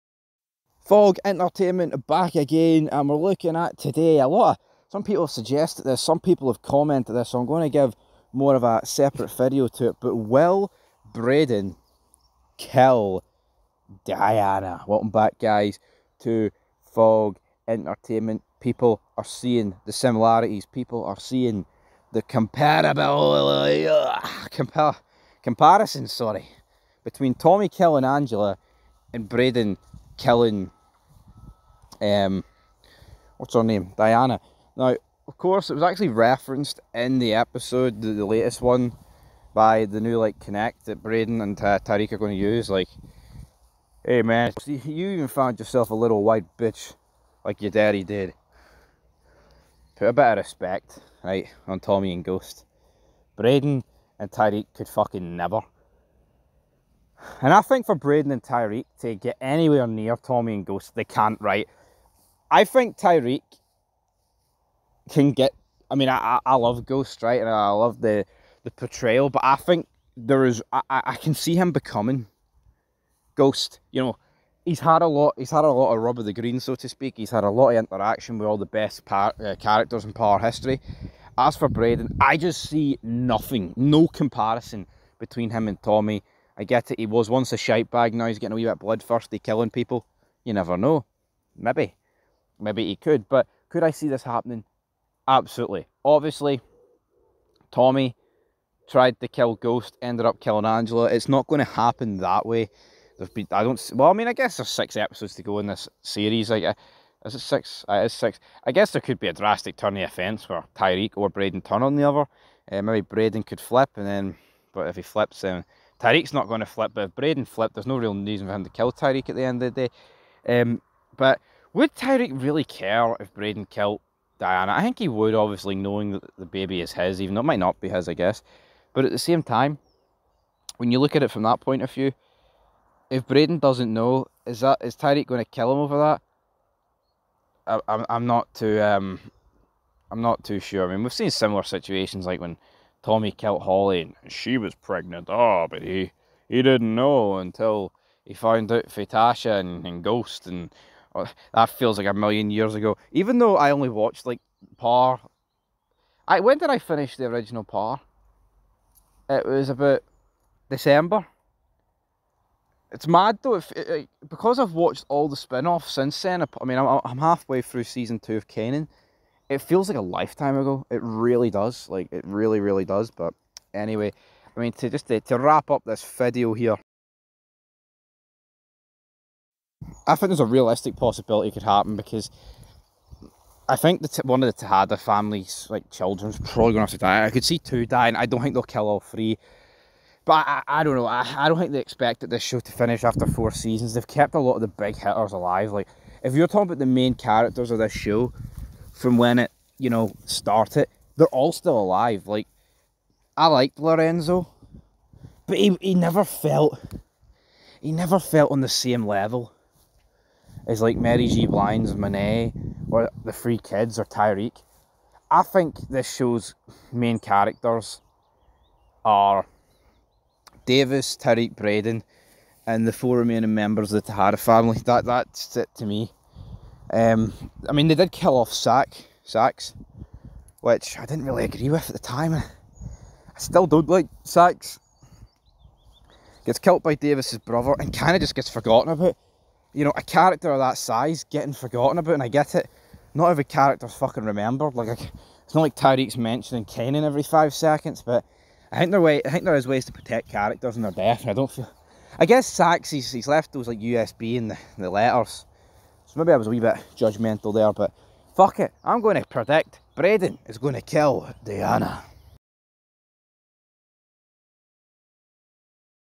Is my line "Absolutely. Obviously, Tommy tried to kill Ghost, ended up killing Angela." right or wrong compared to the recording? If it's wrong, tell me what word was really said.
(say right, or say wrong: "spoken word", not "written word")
right.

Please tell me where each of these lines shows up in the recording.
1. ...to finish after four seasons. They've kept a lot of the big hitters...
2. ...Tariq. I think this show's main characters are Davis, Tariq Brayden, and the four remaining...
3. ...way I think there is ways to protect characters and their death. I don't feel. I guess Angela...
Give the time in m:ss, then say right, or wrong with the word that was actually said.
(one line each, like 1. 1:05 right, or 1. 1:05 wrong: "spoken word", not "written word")
1. 3:12 right
2. 3:34 right
3. 4:09 wrong: "Saxe", not "Angela".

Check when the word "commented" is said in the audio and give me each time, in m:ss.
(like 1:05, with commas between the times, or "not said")
0:06.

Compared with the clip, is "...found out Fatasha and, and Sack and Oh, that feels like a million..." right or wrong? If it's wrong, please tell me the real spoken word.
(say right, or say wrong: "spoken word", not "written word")
wrong: "Ghost", not "Sack".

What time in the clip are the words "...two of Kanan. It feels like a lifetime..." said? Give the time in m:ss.
2:48.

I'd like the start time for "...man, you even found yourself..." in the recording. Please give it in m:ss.
0:44.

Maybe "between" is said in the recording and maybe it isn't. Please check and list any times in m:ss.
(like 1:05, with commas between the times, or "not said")
0:27, 1:25.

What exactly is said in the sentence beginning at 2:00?
Um, but would Tariq really care if Brayden killed Diana?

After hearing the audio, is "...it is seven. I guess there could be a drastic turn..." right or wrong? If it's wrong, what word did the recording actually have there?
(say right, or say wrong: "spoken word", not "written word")
wrong: "six", not "seven".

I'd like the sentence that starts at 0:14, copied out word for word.
Welcome back, guys, to Fog Entertainment.